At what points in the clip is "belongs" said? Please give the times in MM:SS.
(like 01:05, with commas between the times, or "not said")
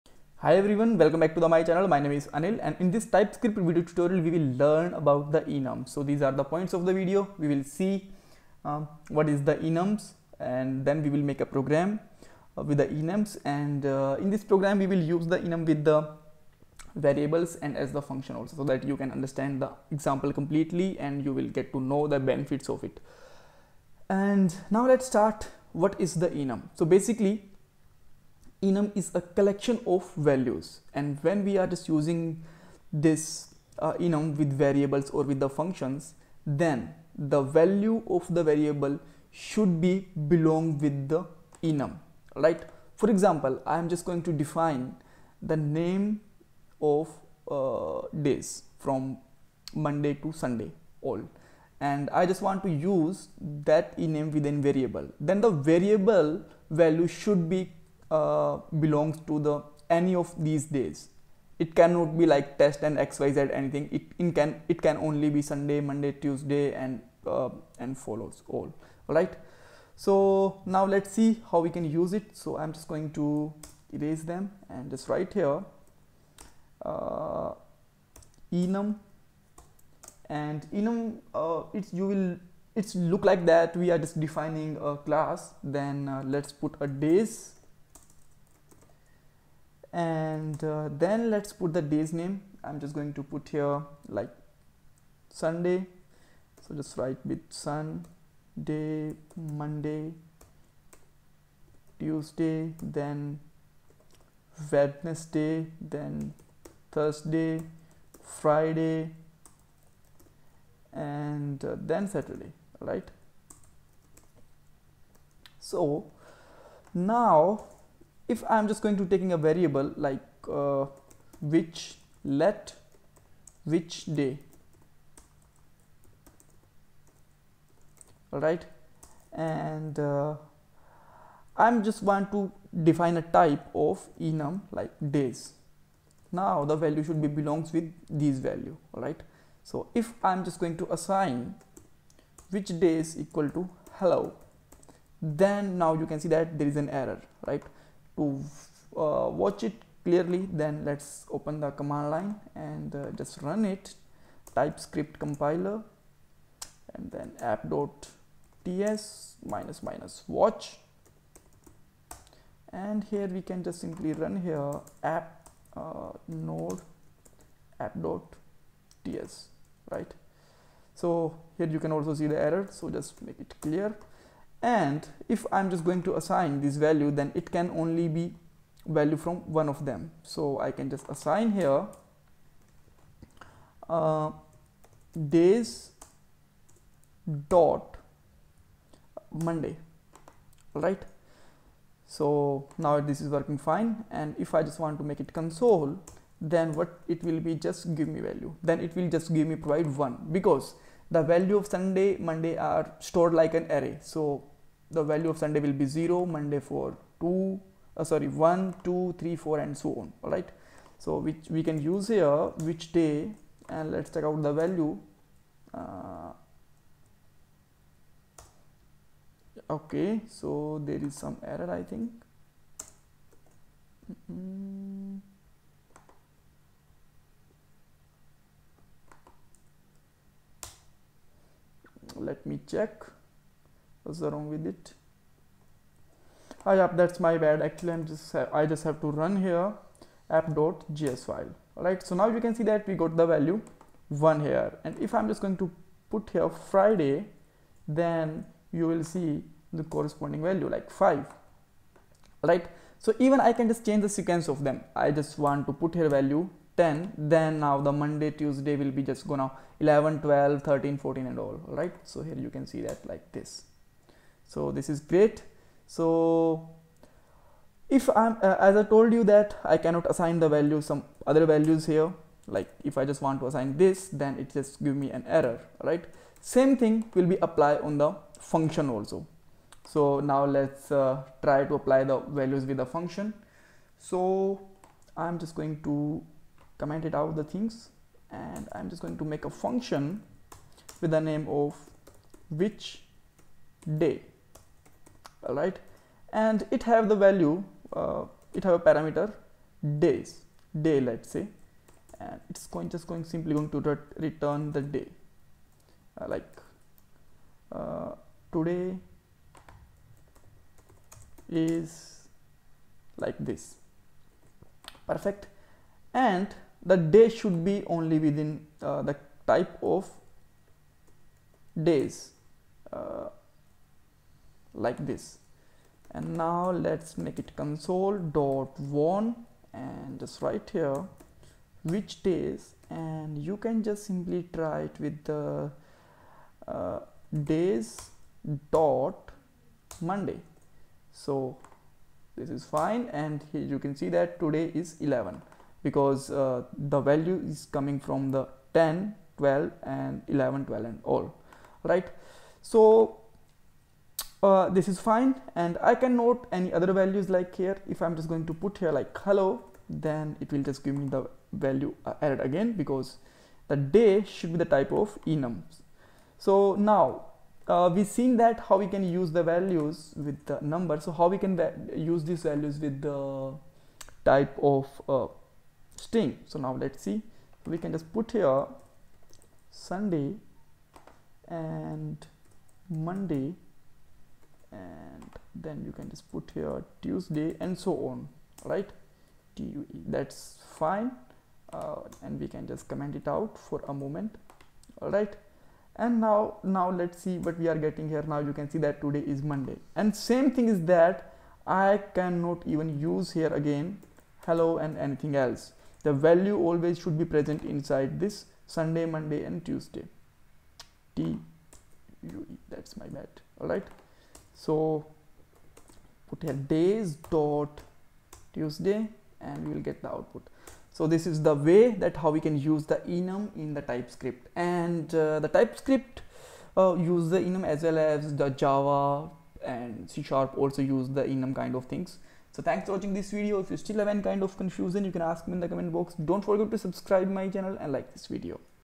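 00:40, 00:58, 02:17.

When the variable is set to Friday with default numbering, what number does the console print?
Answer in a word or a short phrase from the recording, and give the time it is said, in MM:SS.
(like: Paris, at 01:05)
5, at 04:10.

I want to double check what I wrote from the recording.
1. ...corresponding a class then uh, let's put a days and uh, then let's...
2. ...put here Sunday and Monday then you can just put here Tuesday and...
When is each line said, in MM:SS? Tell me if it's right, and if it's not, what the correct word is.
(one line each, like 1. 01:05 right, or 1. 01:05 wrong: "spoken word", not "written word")
1. 01:24 wrong: "defining", not "corresponding"
2. 06:18 right.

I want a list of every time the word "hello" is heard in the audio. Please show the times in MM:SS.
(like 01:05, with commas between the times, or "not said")
02:23, 05:59, 06:44.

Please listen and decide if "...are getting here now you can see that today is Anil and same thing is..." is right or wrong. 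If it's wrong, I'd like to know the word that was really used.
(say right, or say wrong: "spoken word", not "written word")
wrong: "Monday", not "Anil".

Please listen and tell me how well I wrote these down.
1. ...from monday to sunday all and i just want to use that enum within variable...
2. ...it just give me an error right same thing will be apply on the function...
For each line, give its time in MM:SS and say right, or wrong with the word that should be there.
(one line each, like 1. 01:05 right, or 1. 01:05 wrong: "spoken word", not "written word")
1. 00:48 right
2. 04:34 right.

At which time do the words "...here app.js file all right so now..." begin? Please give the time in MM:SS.
03:59.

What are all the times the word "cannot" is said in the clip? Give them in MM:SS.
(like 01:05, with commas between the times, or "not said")
01:01, 04:29, 06:42.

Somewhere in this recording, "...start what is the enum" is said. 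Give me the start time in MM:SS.
00:25.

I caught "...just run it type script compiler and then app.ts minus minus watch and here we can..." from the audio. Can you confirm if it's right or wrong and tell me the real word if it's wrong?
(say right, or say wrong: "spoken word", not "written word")
right.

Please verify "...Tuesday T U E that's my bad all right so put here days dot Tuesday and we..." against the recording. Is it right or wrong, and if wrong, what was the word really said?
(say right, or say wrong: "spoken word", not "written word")
right.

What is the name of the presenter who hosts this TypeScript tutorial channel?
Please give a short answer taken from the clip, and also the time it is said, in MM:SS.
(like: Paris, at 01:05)
Anil, at 00:02.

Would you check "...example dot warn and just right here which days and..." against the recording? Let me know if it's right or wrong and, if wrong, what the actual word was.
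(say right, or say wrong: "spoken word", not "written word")
wrong: "console", not "example".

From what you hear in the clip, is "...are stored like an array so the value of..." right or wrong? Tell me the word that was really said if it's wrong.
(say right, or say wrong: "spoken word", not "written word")
right.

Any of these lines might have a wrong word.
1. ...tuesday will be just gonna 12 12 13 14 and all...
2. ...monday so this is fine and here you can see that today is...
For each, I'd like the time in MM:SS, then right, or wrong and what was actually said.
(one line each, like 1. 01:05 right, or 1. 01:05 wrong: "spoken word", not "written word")
1. 04:18 wrong: "11", not "12"
2. 05:40 right.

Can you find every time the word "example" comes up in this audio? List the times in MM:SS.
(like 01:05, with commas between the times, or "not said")
00:19, 00:43.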